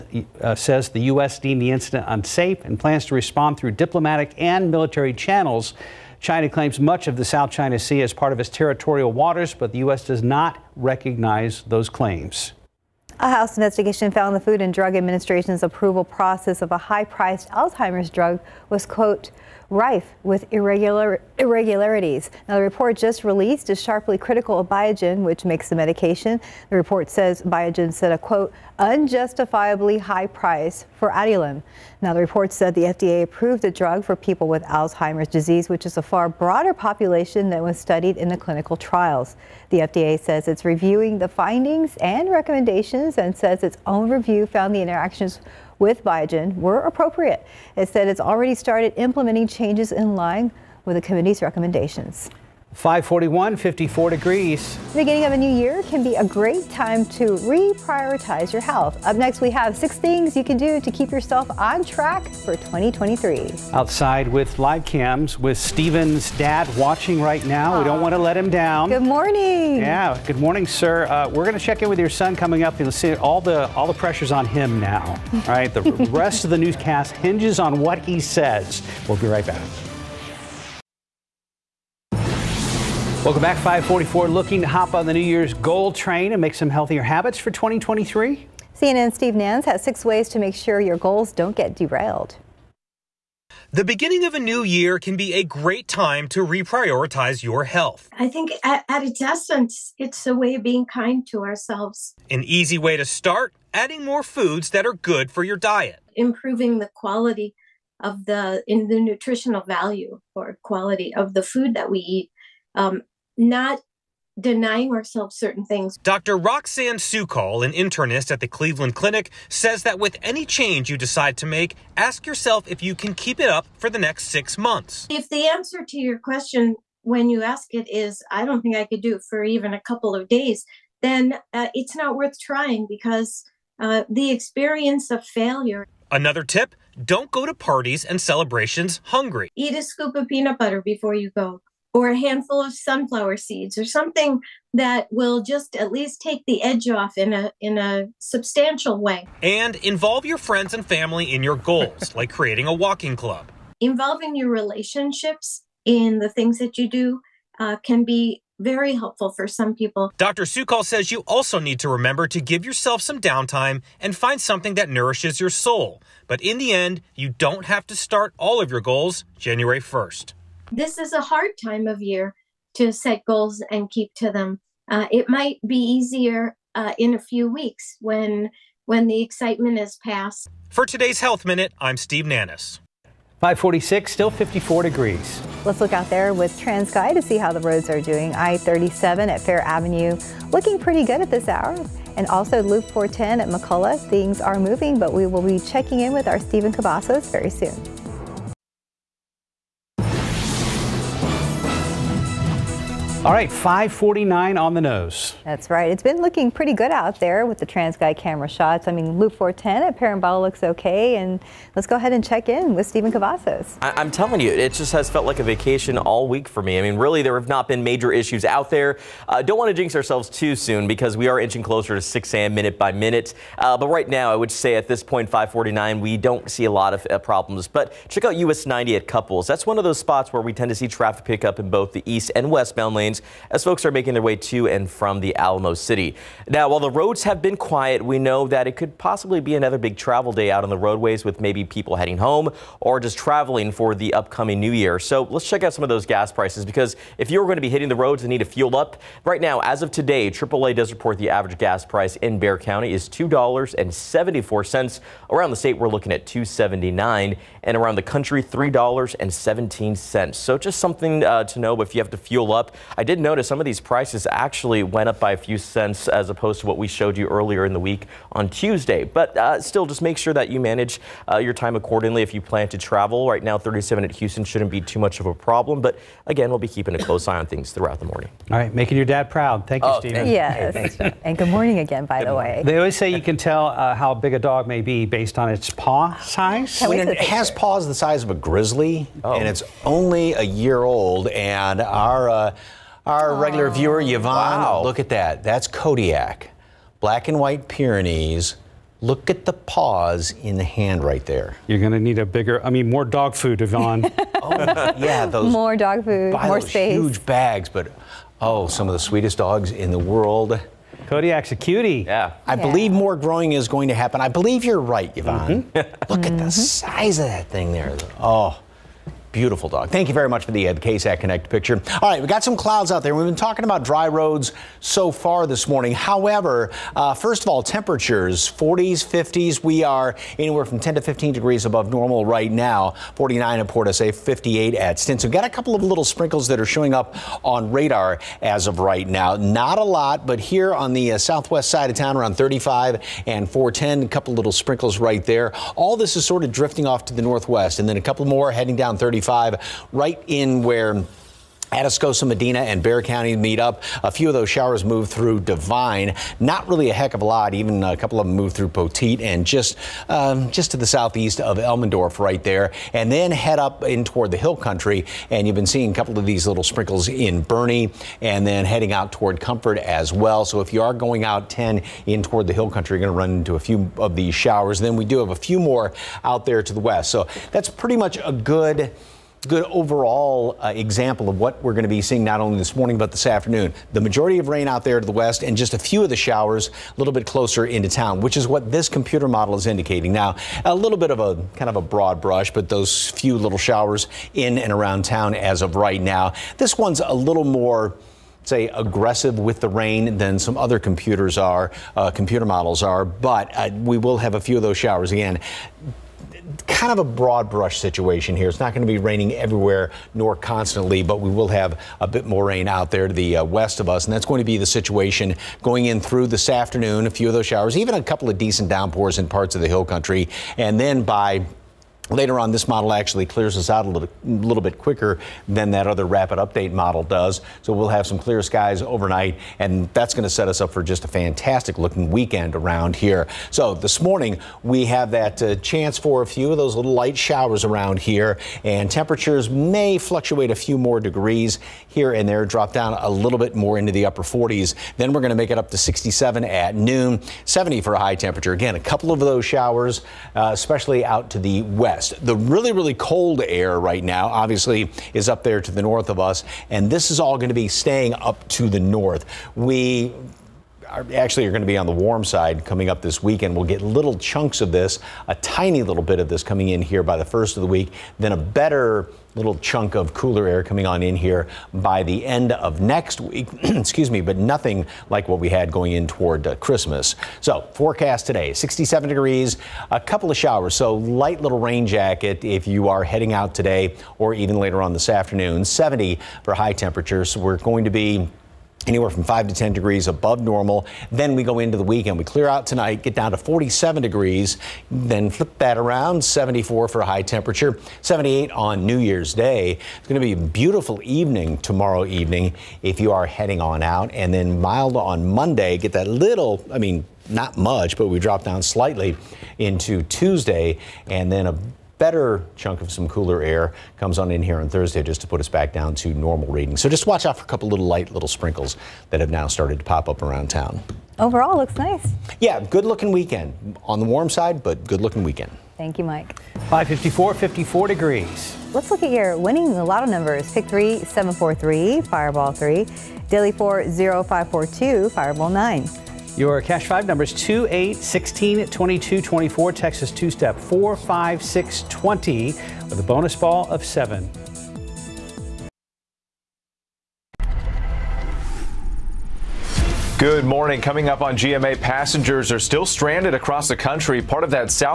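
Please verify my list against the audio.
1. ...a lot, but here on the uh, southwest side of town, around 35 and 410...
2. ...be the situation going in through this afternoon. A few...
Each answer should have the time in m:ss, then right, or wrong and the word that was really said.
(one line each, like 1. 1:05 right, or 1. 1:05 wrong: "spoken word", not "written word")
1. 5:39 right
2. 6:54 right.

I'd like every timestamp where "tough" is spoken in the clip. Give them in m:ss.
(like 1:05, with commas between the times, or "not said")
not said.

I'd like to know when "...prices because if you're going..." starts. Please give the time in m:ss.
4:06.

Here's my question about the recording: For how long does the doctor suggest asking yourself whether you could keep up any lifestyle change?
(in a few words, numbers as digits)
six months.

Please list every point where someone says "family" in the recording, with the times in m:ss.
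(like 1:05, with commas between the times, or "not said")
2:30.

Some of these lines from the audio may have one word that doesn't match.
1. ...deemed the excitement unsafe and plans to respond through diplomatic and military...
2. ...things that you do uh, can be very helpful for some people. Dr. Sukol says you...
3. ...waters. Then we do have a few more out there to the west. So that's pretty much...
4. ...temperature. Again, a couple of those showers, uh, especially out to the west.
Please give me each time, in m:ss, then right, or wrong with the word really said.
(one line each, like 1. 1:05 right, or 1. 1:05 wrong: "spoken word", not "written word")
1. 0:01 wrong: "incident", not "excitement"
2. 2:36 right
3. 6:14 wrong: "showers", not "waters"
4. 7:28 right.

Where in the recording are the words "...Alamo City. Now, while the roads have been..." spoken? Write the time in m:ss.
3:55.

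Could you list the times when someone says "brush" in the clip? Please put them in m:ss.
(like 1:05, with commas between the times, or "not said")
6:32, 6:47.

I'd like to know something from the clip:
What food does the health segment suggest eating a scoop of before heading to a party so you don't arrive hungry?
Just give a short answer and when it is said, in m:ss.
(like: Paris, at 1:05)
peanut butter, at 2:20.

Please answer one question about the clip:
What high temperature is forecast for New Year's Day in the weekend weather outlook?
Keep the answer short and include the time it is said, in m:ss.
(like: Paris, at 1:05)
78, at 8:18.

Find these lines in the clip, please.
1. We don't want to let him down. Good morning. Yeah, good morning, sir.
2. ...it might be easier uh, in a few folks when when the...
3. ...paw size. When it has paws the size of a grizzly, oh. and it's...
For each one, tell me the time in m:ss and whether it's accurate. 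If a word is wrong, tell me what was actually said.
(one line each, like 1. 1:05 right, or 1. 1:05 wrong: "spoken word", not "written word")
1. 1:07 right
2. 2:55 wrong: "weeks", not "folks"
3. 4:45 right.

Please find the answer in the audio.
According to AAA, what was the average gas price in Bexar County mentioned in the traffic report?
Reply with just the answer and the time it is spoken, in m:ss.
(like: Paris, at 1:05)
$2.74, at 4:13.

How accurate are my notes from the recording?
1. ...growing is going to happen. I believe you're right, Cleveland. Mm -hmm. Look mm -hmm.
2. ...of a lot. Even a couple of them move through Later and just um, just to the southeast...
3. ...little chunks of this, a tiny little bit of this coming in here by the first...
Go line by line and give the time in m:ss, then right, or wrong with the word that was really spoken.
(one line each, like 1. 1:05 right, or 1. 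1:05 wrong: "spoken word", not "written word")
1. 5:13 wrong: "Yvonne", not "Cleveland"
2. 5:57 wrong: "Poteet", not "Later"
3. 7:43 right.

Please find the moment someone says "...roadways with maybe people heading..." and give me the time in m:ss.
4:00.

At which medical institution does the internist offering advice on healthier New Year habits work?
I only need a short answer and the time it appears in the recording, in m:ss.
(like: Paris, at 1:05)
Cleveland Clinic, at 1:58.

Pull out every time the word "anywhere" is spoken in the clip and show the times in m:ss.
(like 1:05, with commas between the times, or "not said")
5:30, 8:08.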